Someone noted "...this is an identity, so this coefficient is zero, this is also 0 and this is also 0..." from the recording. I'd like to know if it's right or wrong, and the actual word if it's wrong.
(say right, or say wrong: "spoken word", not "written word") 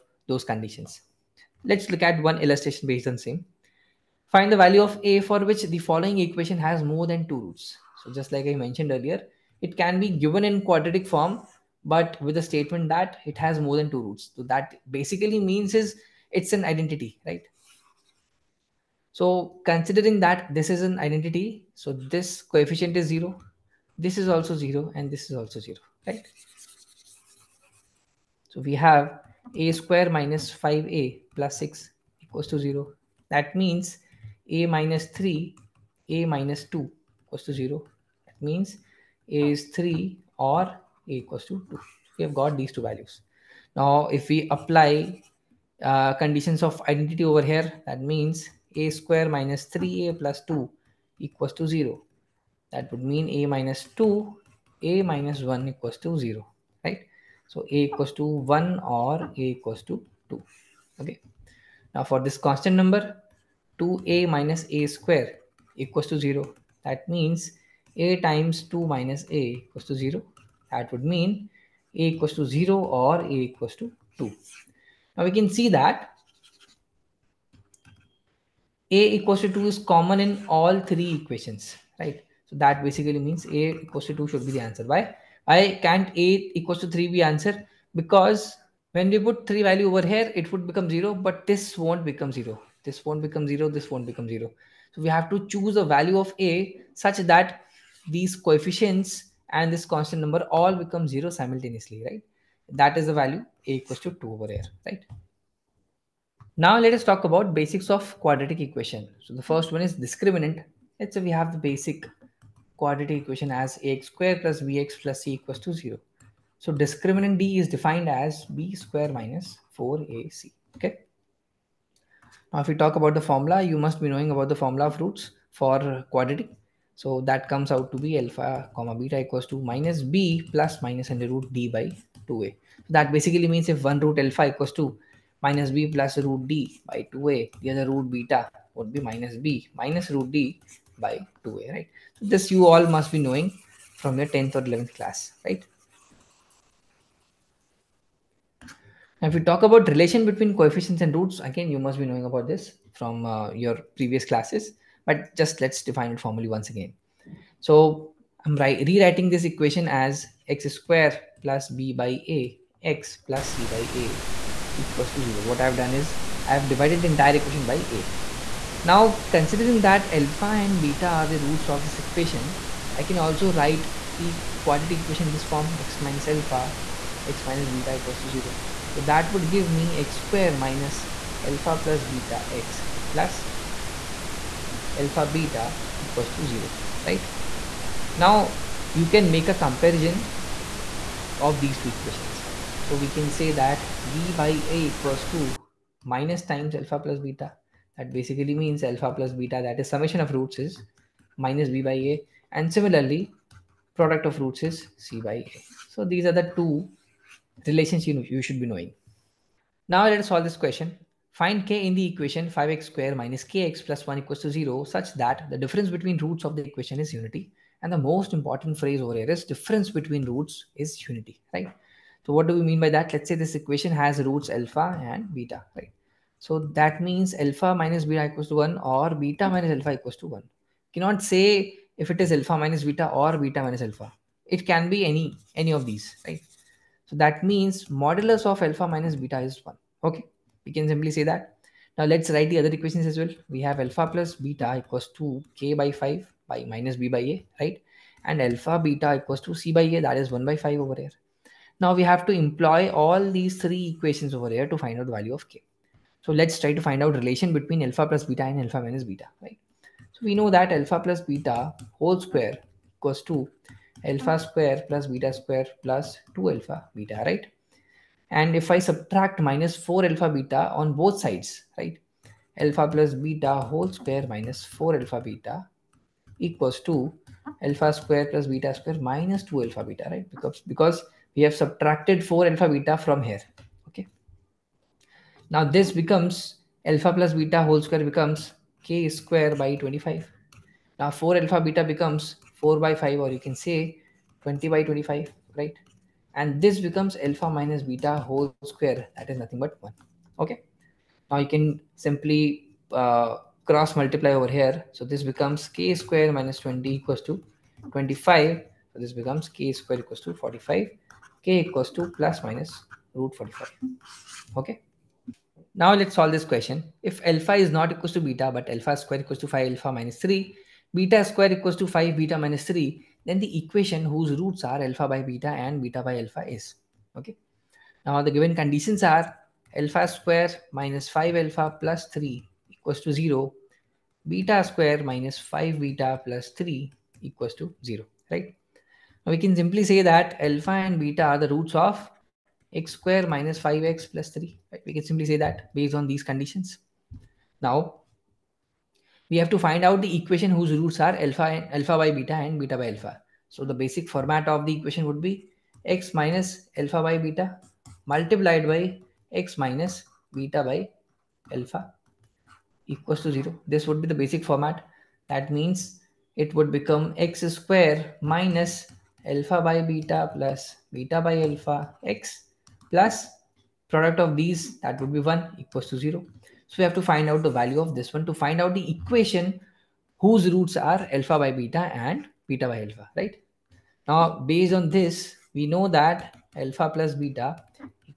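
right.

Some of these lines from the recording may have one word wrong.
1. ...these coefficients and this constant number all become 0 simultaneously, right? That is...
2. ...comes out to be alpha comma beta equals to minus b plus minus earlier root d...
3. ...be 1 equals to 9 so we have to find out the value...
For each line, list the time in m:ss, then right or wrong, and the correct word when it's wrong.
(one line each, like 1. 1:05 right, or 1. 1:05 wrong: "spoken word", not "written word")
1. 1:38 right
2. 2:07 wrong: "under", not "earlier"
3. 6:15 wrong: "0", not "9".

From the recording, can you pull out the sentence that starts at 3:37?
And the most important phrase over here is difference between roots is unity, right?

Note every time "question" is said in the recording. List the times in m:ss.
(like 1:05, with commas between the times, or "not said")
3:30, 5:16.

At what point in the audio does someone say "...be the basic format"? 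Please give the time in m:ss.
6:04.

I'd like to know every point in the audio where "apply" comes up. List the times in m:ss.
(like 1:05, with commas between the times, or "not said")
0:44.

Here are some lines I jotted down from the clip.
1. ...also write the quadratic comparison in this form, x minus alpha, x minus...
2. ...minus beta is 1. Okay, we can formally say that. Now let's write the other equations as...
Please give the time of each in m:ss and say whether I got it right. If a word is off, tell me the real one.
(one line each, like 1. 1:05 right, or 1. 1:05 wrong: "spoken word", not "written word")
1. 2:53 wrong: "equation", not "comparison"
2. 3:58 wrong: "simply", not "formally".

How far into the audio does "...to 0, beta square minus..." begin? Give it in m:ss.
5:33.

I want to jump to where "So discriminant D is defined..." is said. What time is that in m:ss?
1:56.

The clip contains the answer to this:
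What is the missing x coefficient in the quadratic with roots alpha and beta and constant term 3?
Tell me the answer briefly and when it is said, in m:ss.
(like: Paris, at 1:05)
5, at 5:42.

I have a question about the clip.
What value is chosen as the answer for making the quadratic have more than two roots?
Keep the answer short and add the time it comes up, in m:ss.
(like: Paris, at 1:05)
a = 2, at 1:23.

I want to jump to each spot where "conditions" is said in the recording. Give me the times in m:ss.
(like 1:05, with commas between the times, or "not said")
0:00, 0:46, 5:28, 5:46.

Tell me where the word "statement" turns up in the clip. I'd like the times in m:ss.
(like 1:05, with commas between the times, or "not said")
0:12.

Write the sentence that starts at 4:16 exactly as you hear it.
So let's try to find out relation between alpha plus beta and alpha minus beta, right?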